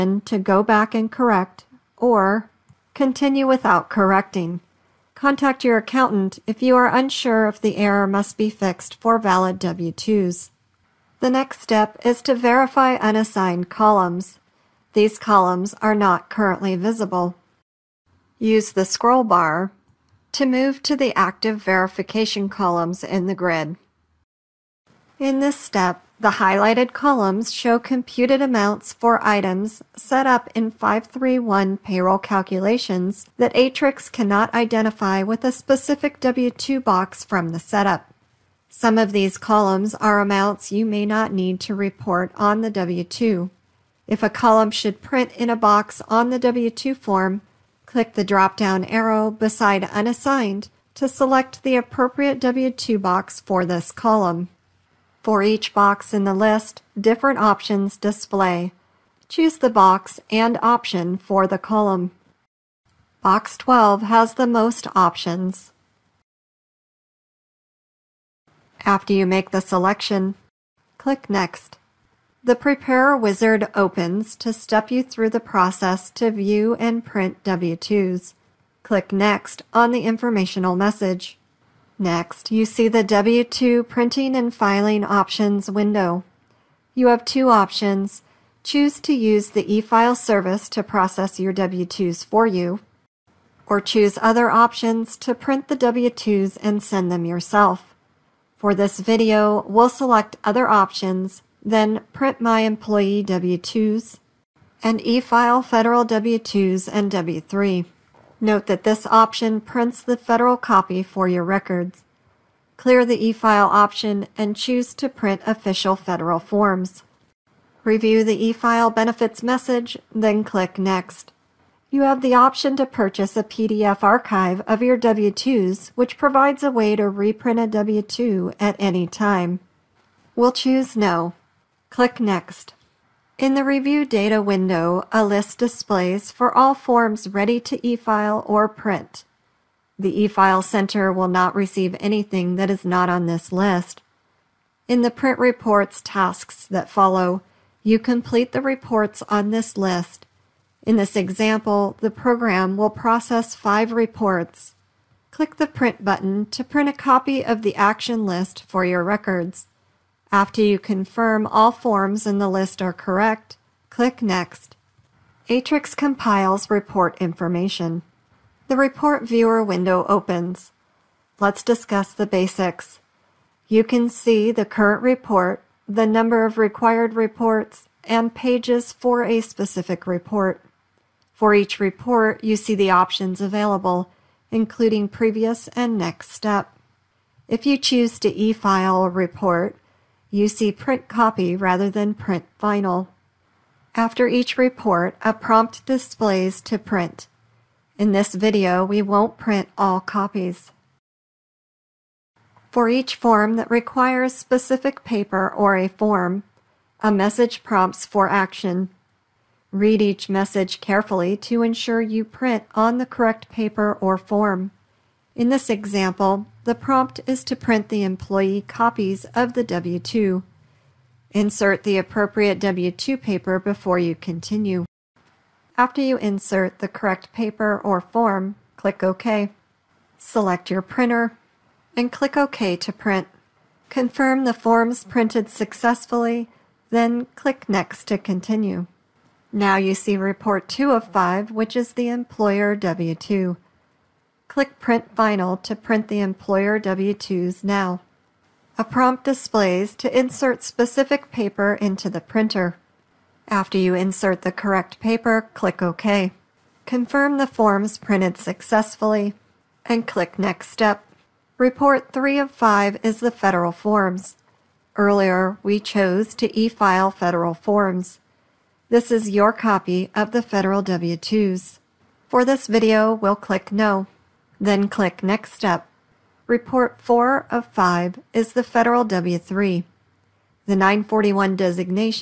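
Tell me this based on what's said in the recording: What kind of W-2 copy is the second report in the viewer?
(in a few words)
Employer W-2.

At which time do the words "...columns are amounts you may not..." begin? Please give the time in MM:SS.
00:39.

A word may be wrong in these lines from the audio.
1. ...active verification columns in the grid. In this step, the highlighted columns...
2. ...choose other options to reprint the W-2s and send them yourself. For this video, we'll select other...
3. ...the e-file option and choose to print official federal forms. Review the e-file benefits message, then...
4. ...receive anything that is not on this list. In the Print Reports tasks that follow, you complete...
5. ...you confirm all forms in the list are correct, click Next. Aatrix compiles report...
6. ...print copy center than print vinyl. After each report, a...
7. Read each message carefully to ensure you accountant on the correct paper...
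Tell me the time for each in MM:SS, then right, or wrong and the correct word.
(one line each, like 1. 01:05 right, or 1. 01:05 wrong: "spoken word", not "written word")
1. 00:21 right
2. 01:33 wrong: "print", not "reprint"
3. 01:53 right
4. 02:21 right
5. 02:40 right
6. 03:10 wrong: "rather", not "center"
7. 03:29 wrong: "print", not "accountant".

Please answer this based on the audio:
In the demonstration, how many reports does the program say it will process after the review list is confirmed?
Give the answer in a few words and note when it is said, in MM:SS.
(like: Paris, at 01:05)
5, at 02:33.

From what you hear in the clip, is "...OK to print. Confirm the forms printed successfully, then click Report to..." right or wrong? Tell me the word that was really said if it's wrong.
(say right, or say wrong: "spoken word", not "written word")
wrong: "Next", not "Report".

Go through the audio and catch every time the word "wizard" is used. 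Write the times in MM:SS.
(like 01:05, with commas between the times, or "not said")
01:13.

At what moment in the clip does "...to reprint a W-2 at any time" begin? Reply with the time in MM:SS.
02:06.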